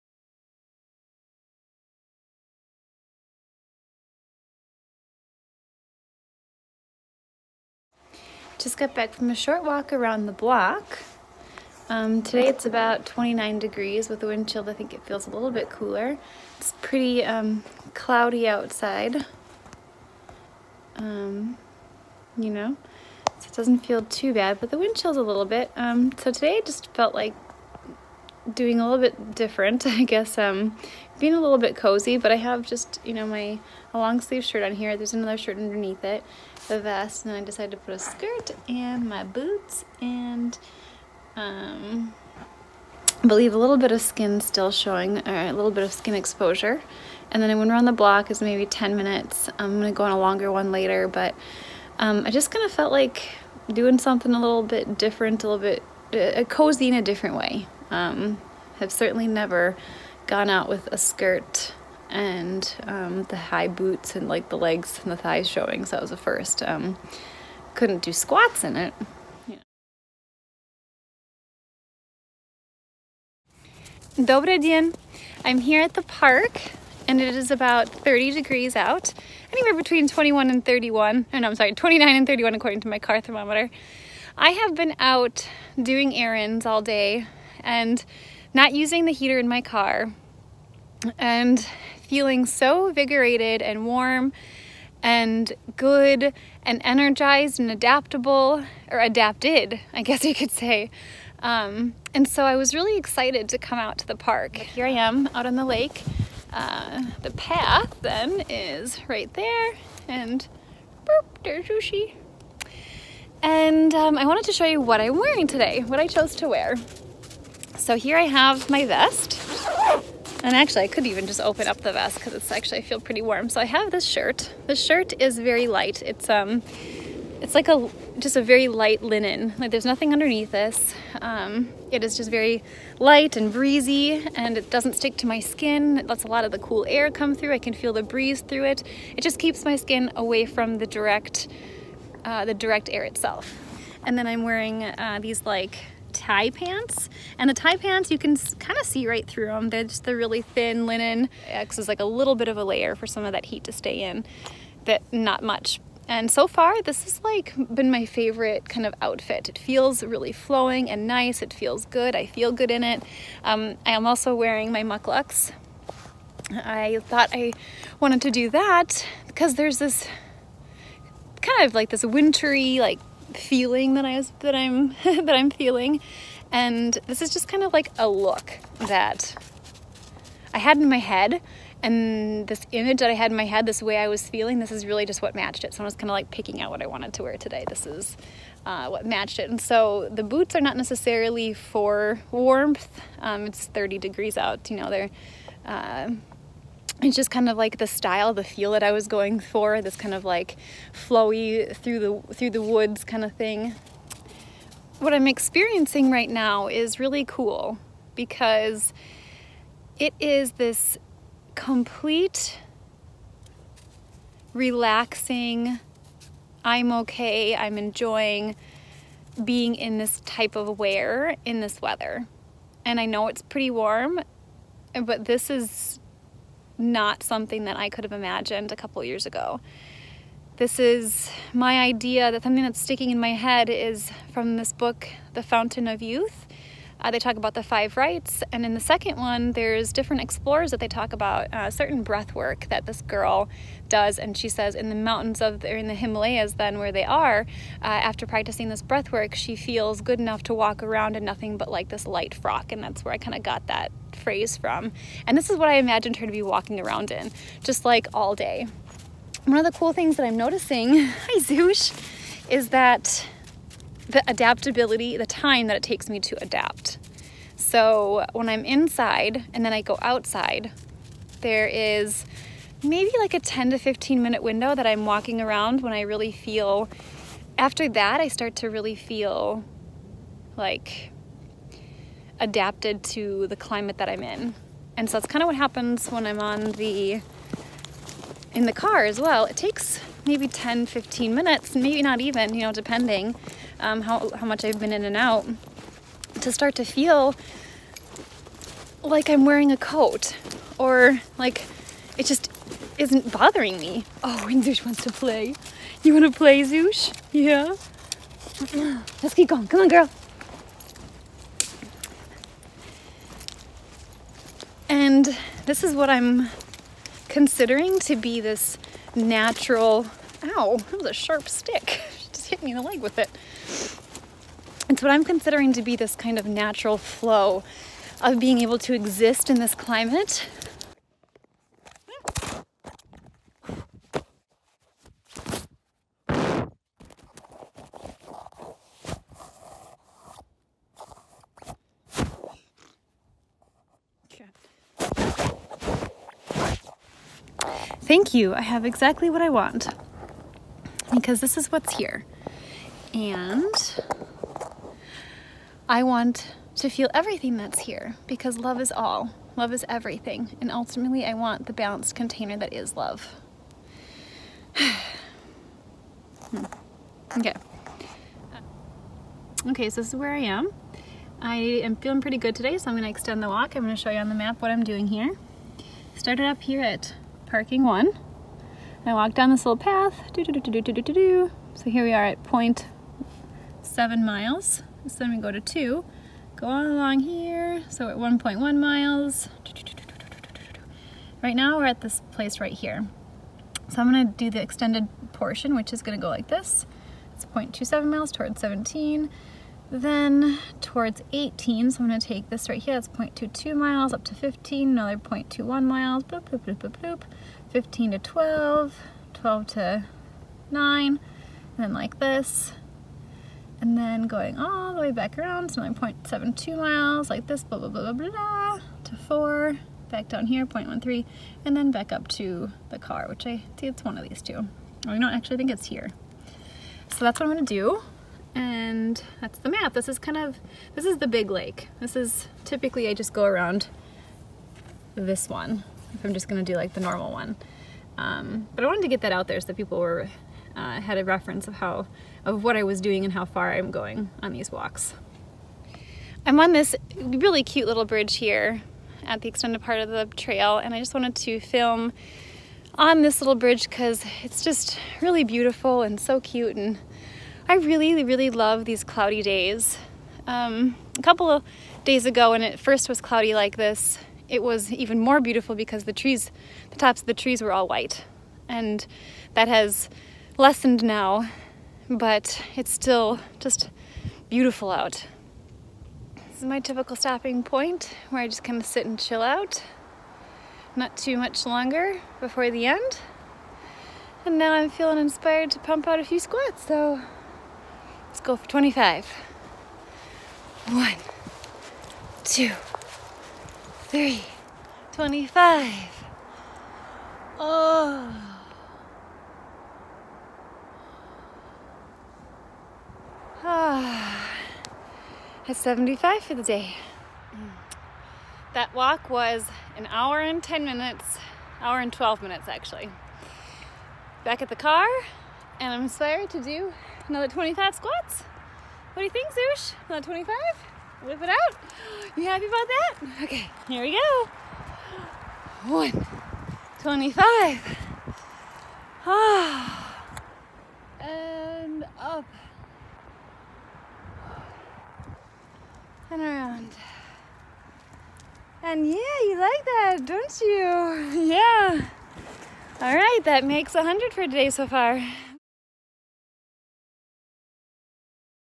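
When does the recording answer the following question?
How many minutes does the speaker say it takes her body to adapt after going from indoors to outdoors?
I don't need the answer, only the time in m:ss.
4:33.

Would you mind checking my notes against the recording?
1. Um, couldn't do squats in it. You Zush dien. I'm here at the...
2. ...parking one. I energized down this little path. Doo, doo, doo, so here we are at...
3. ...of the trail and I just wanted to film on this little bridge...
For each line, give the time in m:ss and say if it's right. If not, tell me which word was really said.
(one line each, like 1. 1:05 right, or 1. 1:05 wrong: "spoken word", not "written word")
1. 1:06 wrong: "Dobre", not "Zush"
2. 6:17 wrong: "walked", not "energized"
3. 7:29 right.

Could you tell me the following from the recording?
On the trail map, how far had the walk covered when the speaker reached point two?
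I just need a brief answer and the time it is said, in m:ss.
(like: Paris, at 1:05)
1.1 miles, at 6:28.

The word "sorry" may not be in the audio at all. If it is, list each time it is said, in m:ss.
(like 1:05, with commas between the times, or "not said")
1:21, 8:36.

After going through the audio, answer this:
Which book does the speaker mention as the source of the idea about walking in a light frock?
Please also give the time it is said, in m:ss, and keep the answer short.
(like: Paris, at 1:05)
The Fountain of Youth, at 3:55.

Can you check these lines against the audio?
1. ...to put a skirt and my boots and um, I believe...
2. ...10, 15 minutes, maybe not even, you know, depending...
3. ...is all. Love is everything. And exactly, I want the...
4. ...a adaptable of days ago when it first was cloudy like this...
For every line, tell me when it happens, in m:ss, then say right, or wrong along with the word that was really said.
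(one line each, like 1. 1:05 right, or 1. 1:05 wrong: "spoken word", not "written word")
1. 0:37 right
2. 4:50 right
3. 5:58 wrong: "ultimately", not "exactly"
4. 7:41 wrong: "couple", not "adaptable".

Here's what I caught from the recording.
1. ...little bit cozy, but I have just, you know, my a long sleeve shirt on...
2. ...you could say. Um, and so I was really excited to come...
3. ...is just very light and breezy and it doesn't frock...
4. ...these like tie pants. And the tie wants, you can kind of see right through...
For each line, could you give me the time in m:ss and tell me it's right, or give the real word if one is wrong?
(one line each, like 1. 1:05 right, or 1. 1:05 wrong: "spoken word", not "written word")
1. 0:31 right
2. 1:40 right
3. 2:12 wrong: "stick", not "frock"
4. 2:25 wrong: "pants", not "wants".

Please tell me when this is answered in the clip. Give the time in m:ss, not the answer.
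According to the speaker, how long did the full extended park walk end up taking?
8:31.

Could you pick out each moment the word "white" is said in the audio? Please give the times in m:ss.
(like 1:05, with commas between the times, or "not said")
7:47.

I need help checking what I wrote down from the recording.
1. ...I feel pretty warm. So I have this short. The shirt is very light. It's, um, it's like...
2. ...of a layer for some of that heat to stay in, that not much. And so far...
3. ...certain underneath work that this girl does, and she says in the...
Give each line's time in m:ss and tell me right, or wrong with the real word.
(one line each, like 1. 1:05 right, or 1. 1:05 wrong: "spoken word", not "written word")
1. 2:02 wrong: "shirt", not "short"
2. 2:32 right
3. 4:01 wrong: "breath", not "underneath".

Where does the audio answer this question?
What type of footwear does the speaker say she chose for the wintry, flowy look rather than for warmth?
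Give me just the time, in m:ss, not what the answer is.
2:44.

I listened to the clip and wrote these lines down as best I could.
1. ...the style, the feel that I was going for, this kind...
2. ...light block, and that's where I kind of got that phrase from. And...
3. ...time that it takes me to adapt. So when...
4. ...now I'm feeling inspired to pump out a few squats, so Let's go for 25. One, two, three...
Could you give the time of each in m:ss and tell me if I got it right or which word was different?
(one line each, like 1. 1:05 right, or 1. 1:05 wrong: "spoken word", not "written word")
1. 3:17 right
2. 4:12 wrong: "frock", not "block"
3. 4:25 right
4. 8:04 right.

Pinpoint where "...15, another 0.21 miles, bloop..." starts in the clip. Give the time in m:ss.
6:44.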